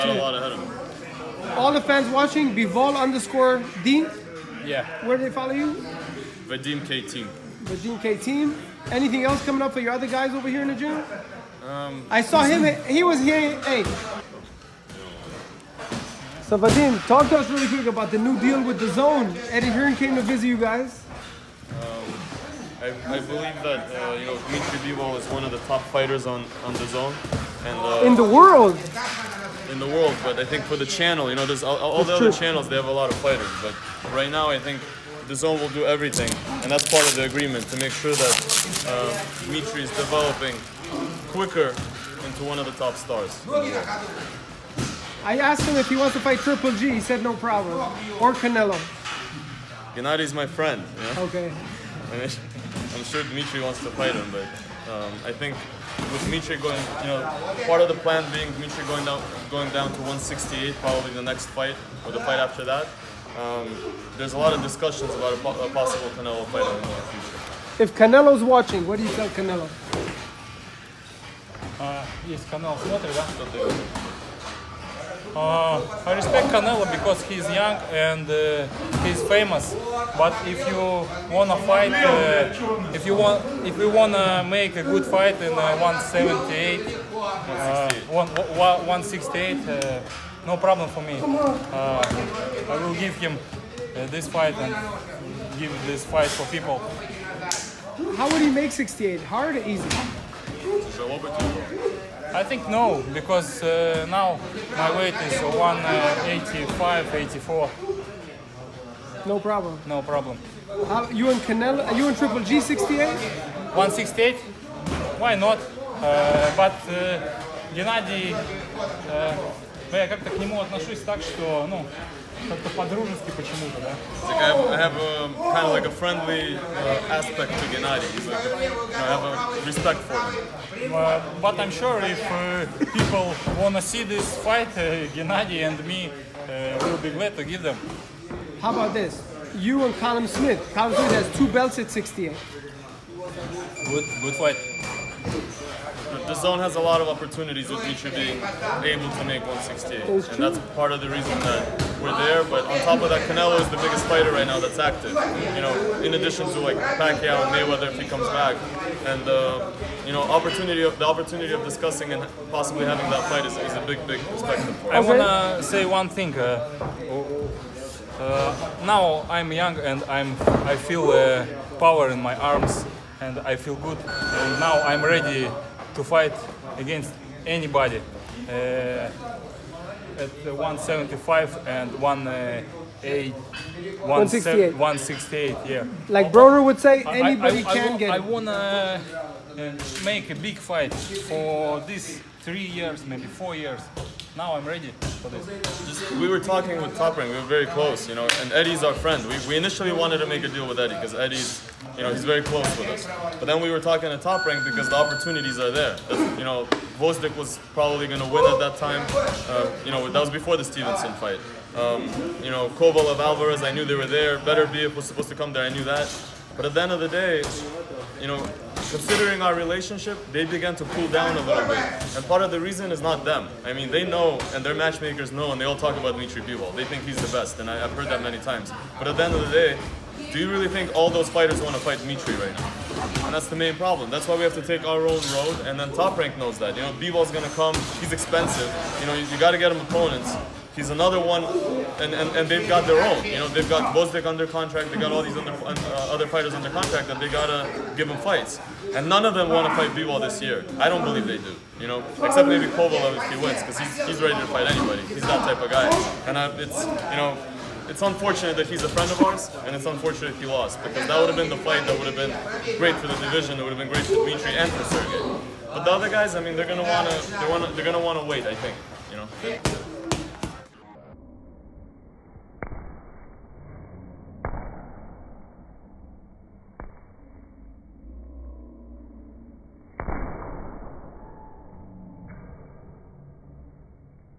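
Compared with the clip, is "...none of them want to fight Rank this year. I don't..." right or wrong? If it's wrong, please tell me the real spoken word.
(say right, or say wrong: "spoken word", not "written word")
wrong: "Bivol", not "Rank".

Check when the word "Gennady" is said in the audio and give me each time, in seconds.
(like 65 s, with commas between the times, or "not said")
49 s, 127 s, 135 s.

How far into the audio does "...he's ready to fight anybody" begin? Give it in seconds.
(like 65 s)
254 s.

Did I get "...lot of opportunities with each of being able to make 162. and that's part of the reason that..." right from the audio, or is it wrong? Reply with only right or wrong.
wrong.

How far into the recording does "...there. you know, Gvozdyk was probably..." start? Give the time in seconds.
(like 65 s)
205 s.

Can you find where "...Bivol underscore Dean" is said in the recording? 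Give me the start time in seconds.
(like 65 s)
2 s.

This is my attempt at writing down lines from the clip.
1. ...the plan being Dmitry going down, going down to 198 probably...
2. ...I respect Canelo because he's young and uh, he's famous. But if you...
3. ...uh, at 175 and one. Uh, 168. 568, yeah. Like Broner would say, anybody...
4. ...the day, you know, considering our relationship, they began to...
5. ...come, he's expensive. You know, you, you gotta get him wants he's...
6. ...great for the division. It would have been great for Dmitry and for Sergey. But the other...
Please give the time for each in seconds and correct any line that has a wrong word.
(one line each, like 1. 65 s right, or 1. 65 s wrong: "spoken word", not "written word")
1. 57 s wrong: "168", not "198"
2. 76 s right
3. 178 s wrong: "168", not "568"
4. 216 s right
5. 237 s wrong: "opponents", not "wants"
6. 262 s right.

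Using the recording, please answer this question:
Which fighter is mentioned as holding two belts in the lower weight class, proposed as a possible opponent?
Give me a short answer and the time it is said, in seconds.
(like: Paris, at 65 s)
Callum Smith, at 140 s.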